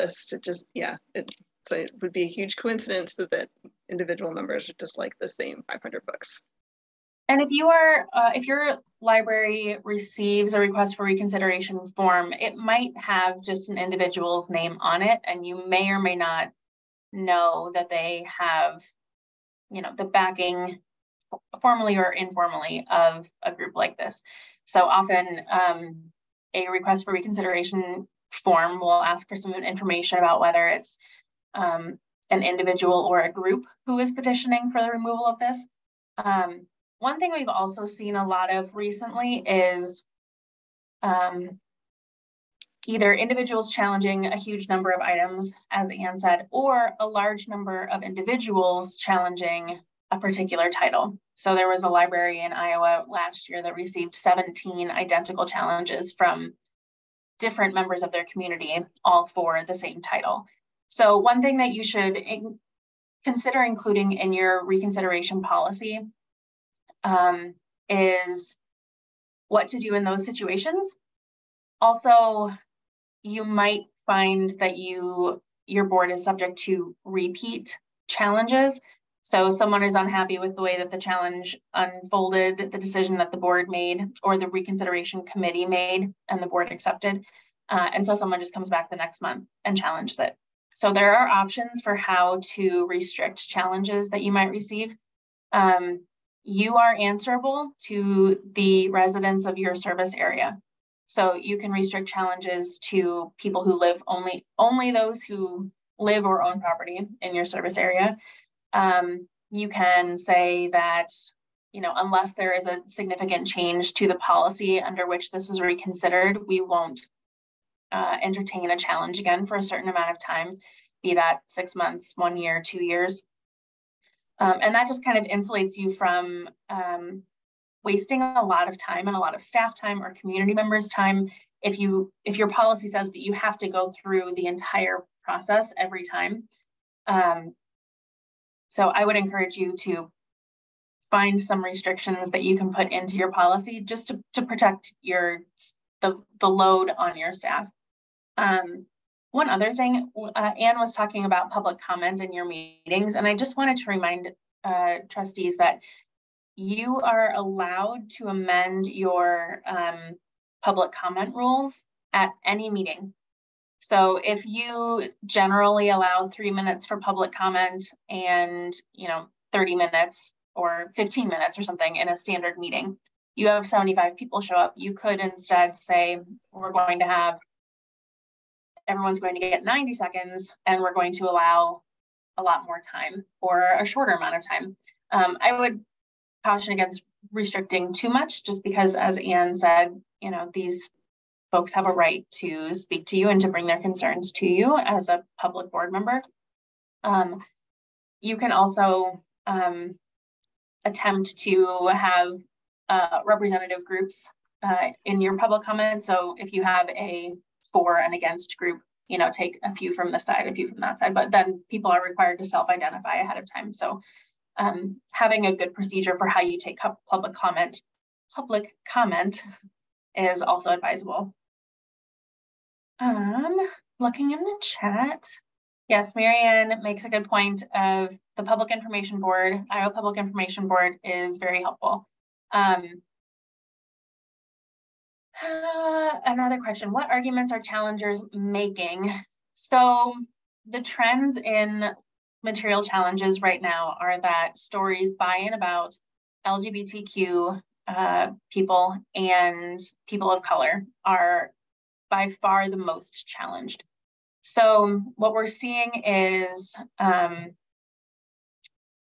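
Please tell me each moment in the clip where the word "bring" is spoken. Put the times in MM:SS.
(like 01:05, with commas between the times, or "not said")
03:13.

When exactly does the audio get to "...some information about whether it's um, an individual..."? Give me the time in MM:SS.
00:29.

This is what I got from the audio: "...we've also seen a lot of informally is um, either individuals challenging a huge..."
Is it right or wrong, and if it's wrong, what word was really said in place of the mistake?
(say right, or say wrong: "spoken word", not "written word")
wrong: "recently", not "informally".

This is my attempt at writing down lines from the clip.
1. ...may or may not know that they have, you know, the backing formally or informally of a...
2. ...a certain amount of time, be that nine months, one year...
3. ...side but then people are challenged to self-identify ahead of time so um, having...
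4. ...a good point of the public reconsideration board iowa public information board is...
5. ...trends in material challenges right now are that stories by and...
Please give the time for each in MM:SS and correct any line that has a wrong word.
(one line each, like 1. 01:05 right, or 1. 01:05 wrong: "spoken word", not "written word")
1. 00:15 right
2. 01:59 wrong: "six", not "nine"
3. 03:30 wrong: "required", not "challenged"
4. 03:47 wrong: "information", not "reconsideration"
5. 04:00 right.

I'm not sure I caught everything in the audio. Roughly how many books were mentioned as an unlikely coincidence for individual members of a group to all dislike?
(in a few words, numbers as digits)
500.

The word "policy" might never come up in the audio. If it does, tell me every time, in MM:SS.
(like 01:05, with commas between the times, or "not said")
01:05, 01:54, 02:12, 02:23.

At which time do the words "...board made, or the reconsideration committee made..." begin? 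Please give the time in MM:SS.
01:23.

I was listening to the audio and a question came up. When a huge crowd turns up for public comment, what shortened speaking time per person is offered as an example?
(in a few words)
90 seconds.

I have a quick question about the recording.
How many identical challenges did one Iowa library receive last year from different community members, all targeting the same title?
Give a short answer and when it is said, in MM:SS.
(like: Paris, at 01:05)
17, at 00:54.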